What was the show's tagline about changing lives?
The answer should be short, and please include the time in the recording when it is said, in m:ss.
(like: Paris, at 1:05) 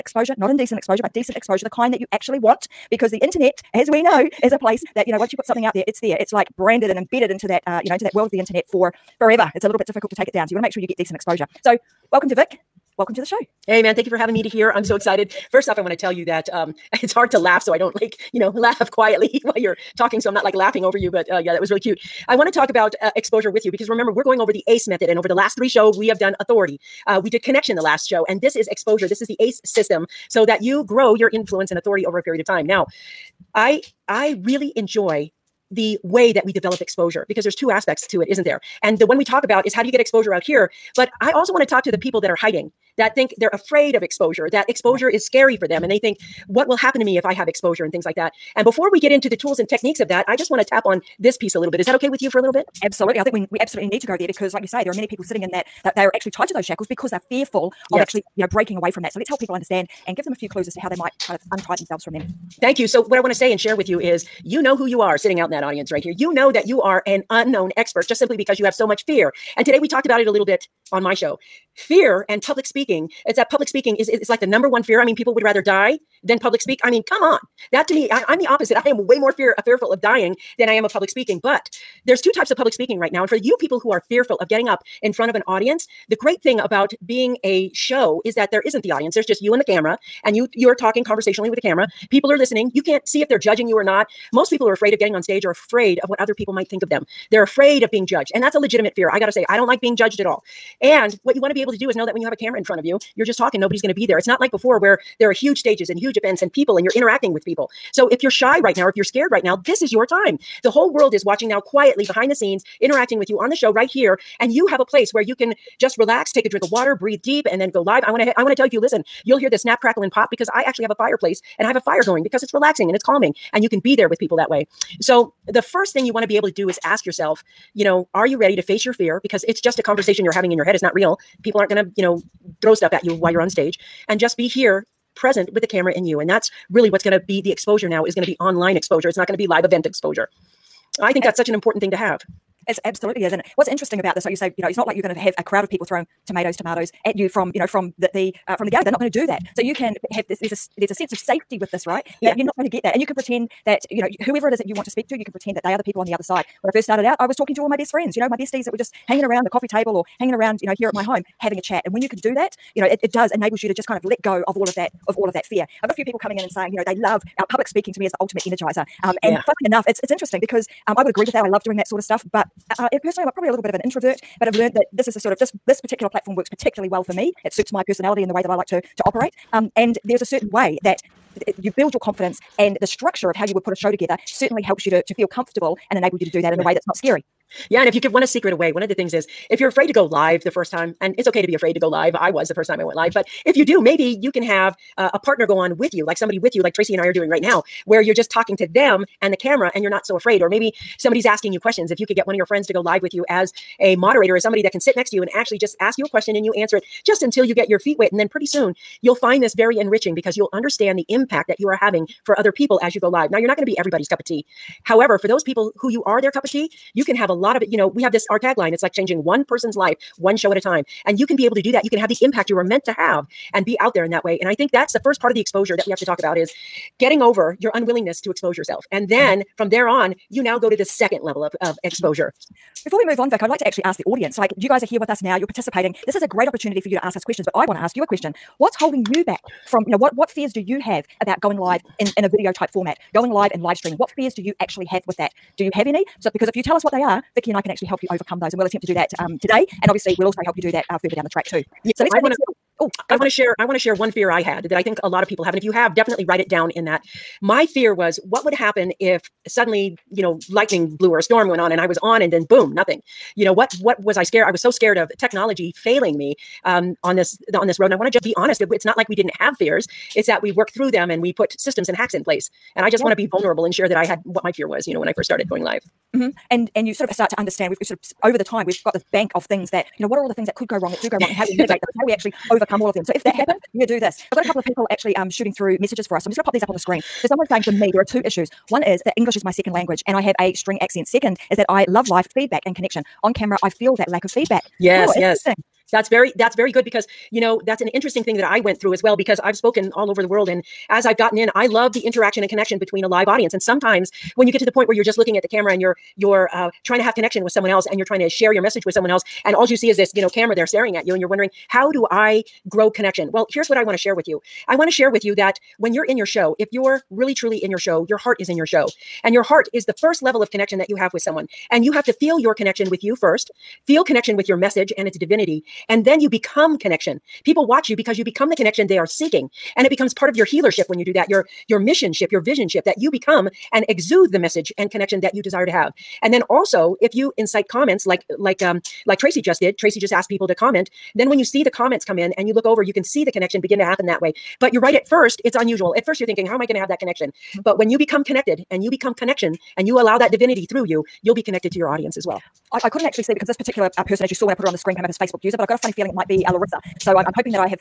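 changing one person's life one show at a time, at 3:38.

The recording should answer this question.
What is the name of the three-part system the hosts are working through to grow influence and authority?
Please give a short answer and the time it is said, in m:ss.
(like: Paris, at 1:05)
ACE method, at 0:24.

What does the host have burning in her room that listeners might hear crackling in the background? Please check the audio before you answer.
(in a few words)
a fireplace.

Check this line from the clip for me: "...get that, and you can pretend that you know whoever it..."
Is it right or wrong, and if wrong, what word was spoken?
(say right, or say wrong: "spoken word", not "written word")
right.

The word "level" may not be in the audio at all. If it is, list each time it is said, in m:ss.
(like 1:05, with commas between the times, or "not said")
3:51, 5:20.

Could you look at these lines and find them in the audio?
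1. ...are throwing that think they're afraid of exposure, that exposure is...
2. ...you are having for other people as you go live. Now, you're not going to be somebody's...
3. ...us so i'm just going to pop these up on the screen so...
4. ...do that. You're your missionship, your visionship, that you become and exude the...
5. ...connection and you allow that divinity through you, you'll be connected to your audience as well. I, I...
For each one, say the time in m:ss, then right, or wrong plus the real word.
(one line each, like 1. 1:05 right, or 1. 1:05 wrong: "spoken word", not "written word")
1. 0:42 wrong: "hiding", not "throwing"
2. 3:31 wrong: "everybody", not "somebody"
3. 4:46 right
4. 5:31 right
5. 5:49 right.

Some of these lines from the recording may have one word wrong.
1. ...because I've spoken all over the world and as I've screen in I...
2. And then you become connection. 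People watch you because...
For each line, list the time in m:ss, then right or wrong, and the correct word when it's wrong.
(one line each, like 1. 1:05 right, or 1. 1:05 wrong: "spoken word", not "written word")
1. 4:59 wrong: "gotten", not "screen"
2. 5:25 right.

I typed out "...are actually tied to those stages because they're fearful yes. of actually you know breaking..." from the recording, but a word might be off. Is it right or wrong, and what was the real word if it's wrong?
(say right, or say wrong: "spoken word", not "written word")
wrong: "shackles", not "stages".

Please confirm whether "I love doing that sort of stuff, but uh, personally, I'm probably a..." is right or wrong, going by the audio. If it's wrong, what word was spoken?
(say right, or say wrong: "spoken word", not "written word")
right.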